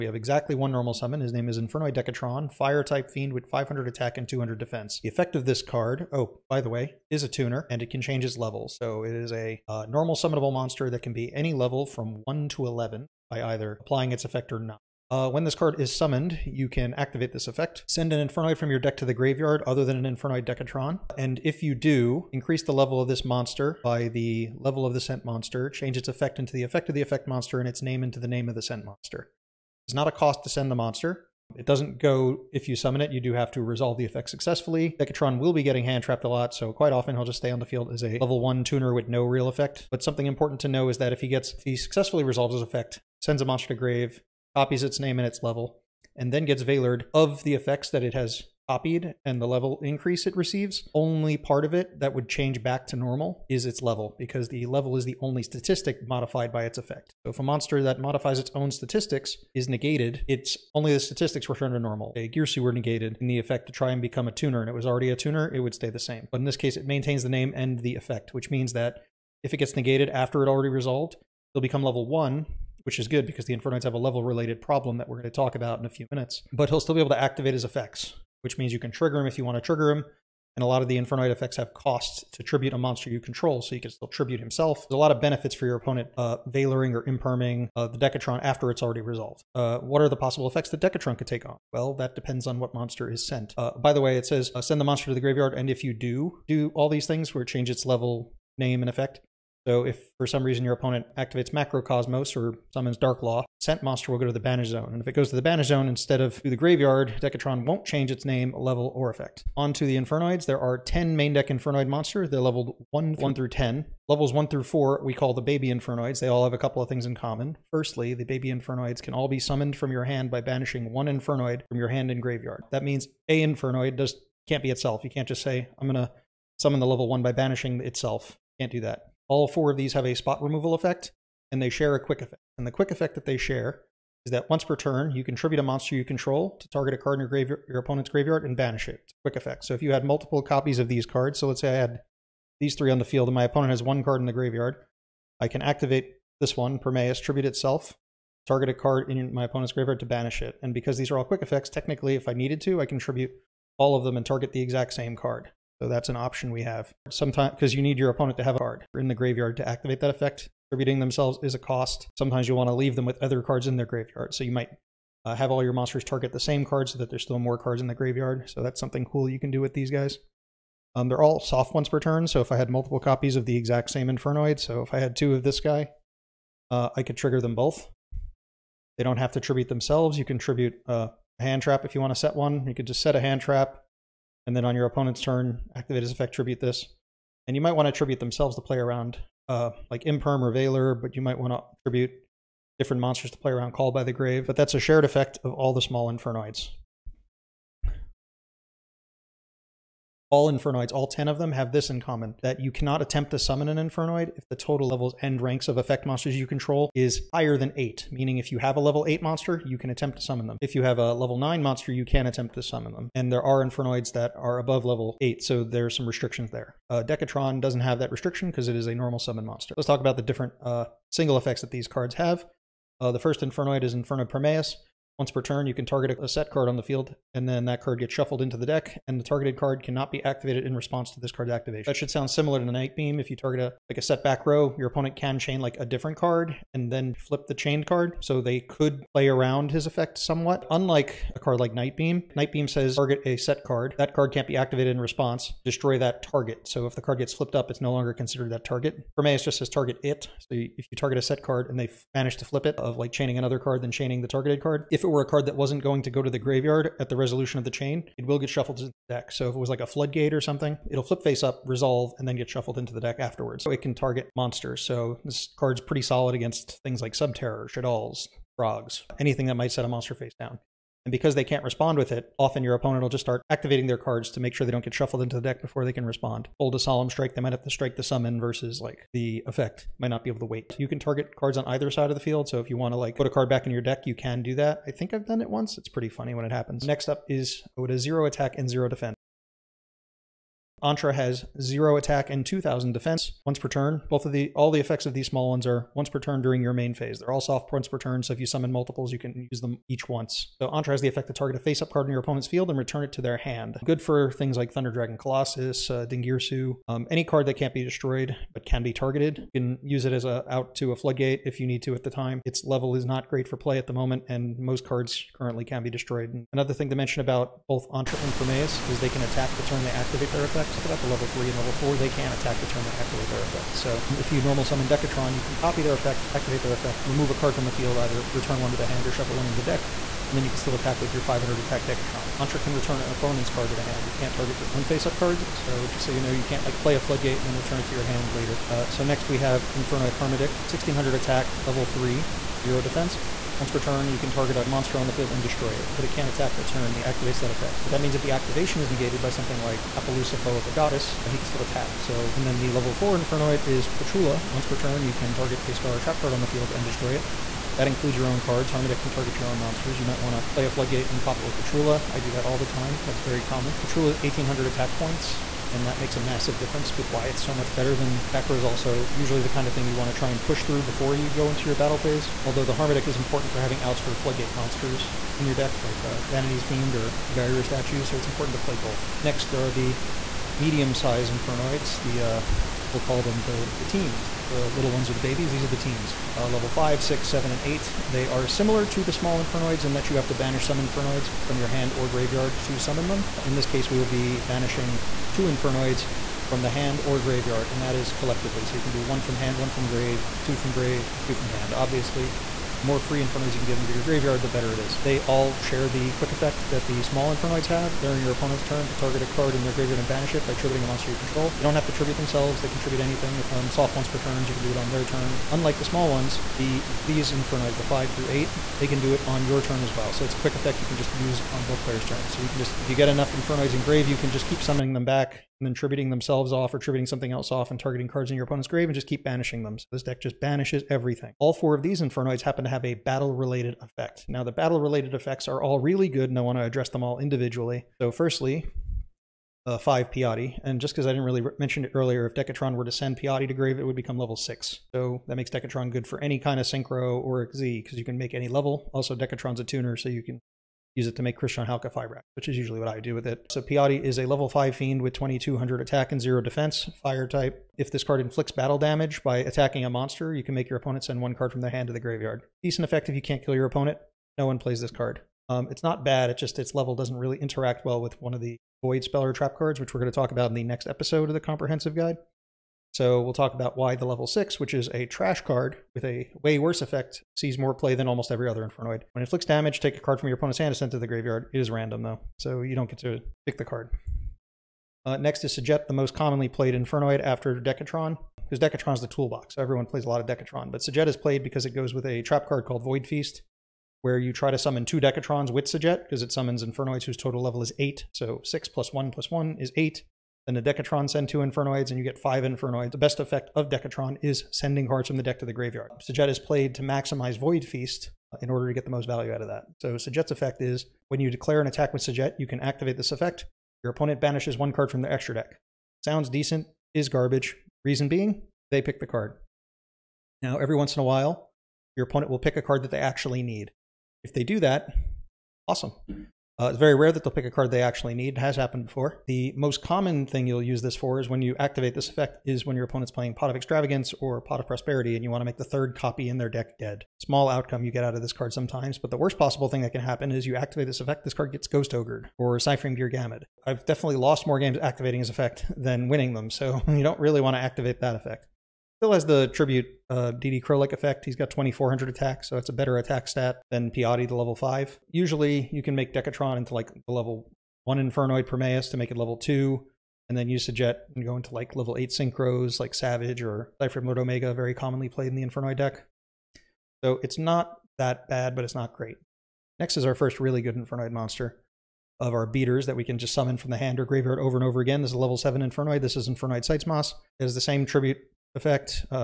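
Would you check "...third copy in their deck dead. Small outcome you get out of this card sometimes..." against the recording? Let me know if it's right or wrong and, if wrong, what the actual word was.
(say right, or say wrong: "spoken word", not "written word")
right.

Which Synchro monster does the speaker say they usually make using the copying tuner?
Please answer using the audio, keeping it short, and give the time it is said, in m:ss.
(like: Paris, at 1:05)
Crystron Halqifibrax, at 7:31.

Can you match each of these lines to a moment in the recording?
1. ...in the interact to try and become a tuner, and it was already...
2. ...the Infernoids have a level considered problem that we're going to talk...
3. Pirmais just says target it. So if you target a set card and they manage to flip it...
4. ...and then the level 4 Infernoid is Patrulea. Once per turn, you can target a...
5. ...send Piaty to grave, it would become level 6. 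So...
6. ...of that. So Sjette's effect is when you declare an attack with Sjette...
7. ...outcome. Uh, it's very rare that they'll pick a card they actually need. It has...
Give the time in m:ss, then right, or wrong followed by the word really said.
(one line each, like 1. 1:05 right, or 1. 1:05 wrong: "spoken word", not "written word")
1. 1:03 wrong: "effect", not "interact"
2. 1:13 wrong: "related", not "considered"
3. 4:09 right
4. 5:52 right
5. 7:22 right
6. 8:29 right
7. 8:45 wrong: "awesome", not "outcome".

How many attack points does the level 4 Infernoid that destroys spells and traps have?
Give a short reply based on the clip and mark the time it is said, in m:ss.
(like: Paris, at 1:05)
1800, at 6:04.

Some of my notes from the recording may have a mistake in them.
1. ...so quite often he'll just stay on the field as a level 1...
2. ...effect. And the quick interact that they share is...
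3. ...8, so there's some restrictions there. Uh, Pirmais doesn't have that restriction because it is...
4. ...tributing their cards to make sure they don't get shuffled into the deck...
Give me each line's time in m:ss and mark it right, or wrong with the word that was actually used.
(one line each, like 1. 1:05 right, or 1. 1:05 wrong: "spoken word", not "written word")
1. 0:36 right
2. 2:12 wrong: "effect", not "interact"
3. 3:35 wrong: "Decatron", not "Pirmais"
4. 4:33 wrong: "activating", not "tributing".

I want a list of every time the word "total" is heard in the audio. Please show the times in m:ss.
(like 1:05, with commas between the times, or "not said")
3:24, 8:17.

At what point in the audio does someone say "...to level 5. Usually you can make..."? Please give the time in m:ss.
9:14.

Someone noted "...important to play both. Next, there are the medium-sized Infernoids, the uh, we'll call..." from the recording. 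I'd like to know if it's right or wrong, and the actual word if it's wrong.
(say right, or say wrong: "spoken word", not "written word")
right.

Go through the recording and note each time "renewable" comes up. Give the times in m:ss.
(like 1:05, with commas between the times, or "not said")
not said.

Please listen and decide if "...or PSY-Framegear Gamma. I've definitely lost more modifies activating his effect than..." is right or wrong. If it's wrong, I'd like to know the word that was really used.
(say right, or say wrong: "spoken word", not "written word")
wrong: "games", not "modifies".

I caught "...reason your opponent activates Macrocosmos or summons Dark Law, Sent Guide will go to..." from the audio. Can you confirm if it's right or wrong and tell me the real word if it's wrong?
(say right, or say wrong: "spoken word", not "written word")
wrong: "Monster", not "Guide".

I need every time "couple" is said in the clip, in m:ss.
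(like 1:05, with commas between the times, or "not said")
1:56.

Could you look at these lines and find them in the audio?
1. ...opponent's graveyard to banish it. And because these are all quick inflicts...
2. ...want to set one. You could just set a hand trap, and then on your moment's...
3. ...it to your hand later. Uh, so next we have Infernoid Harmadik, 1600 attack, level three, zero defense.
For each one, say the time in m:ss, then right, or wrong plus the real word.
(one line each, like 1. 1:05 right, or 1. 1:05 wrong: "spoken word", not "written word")
1. 2:29 wrong: "effects", not "inflicts"
2. 3:02 wrong: "opponent", not "moment"
3. 5:37 right.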